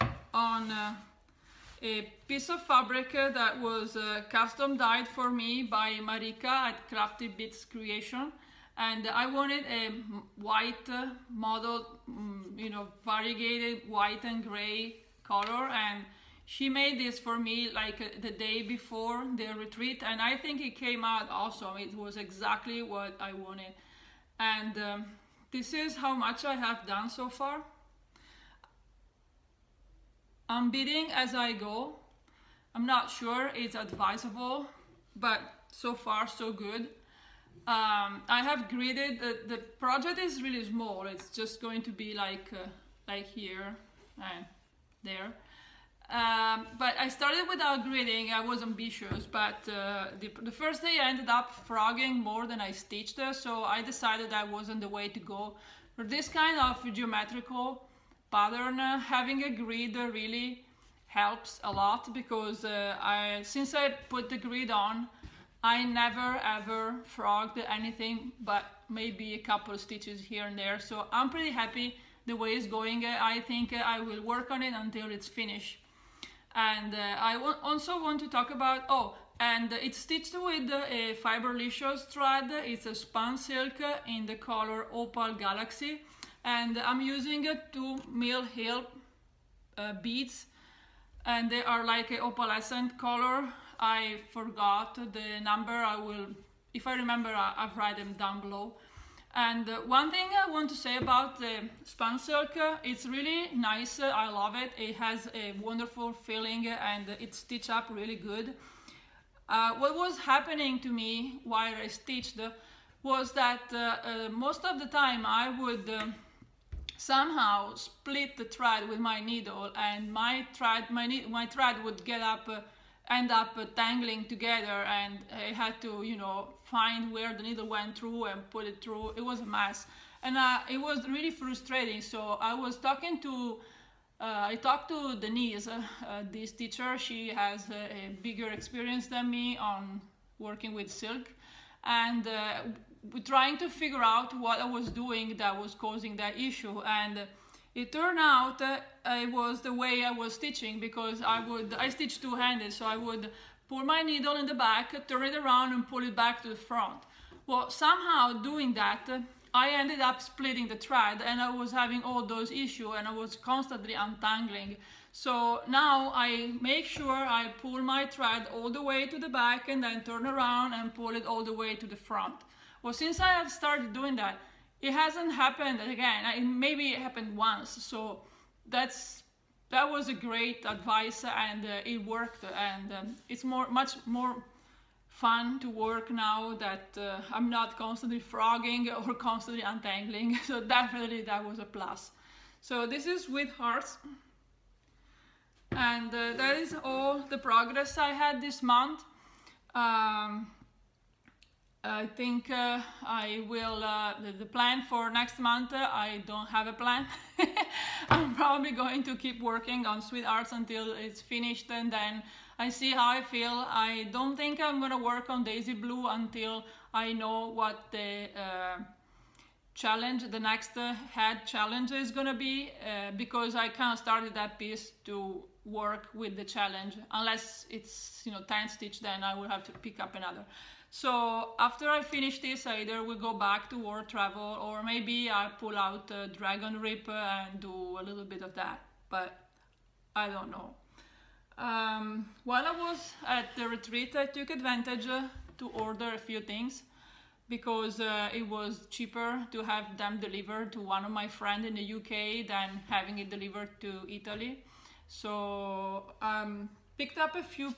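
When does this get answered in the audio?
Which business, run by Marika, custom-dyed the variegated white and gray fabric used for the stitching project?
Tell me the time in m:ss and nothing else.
0:06.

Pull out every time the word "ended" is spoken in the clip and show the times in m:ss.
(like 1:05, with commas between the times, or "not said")
0:51, 2:39.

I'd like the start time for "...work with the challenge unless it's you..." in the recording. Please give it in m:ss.
3:45.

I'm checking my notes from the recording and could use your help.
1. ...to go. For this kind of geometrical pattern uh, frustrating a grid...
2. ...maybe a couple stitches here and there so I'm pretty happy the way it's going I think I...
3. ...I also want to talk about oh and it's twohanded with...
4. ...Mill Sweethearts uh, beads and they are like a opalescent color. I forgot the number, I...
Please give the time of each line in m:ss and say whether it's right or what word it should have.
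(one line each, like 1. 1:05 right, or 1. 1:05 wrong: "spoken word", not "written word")
1. 0:55 wrong: "having", not "frustrating"
2. 1:08 right
3. 1:17 wrong: "stitched", not "twohanded"
4. 1:28 wrong: "Hill", not "Sweethearts".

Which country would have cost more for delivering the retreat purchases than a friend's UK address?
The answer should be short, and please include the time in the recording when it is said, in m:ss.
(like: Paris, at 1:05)
Italy, at 4:14.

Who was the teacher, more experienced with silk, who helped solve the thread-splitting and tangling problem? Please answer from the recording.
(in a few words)
Denise.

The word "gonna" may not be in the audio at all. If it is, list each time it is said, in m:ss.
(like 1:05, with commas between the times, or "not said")
3:34, 3:42.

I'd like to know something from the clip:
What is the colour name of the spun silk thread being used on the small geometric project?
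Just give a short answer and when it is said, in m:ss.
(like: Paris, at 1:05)
Opal Galaxy, at 1:24.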